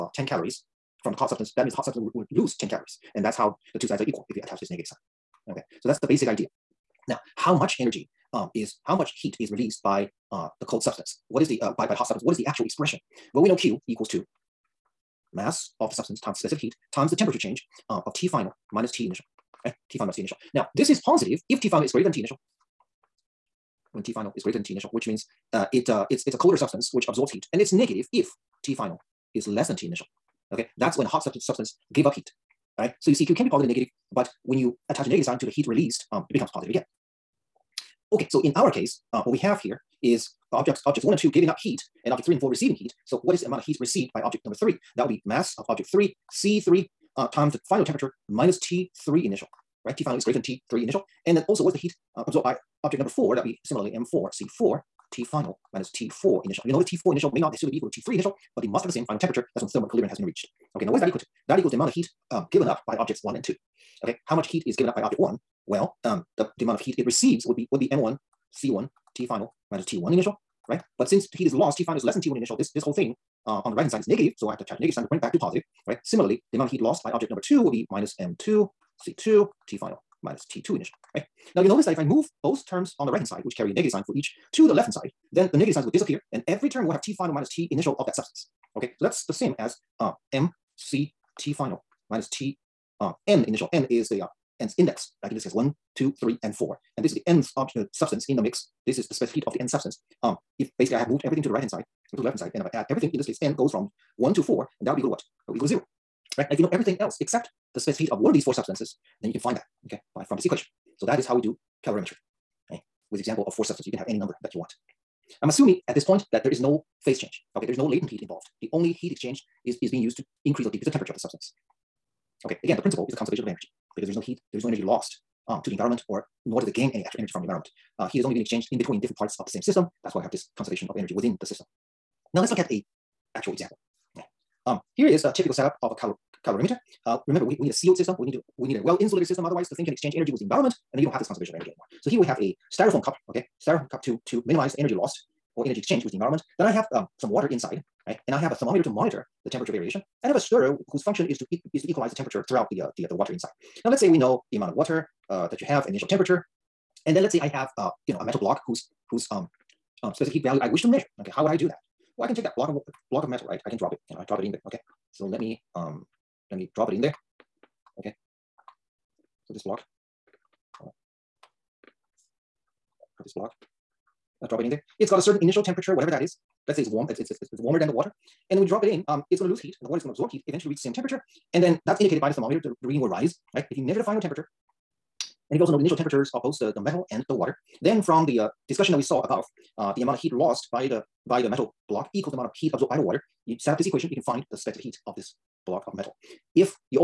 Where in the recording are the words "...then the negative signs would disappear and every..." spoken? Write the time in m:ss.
1:25.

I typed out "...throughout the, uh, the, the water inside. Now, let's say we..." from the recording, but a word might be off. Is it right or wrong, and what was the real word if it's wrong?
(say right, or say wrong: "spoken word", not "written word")
right.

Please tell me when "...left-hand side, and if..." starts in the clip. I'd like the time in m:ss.
1:42.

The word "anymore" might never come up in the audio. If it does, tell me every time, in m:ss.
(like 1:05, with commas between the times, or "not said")
2:21.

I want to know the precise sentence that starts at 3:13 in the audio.
You set up this equation, you can find the specific heat of this block of metal.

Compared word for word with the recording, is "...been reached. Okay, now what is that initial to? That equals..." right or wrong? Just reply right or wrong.
wrong.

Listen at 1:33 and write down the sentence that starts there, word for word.
N is the uh, N's index, like in this case, one two, three, and four.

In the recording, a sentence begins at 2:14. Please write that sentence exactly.
Um, here is a typical setup of a color, calorimeter.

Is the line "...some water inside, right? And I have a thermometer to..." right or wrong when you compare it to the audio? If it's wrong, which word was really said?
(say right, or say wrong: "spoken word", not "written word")
right.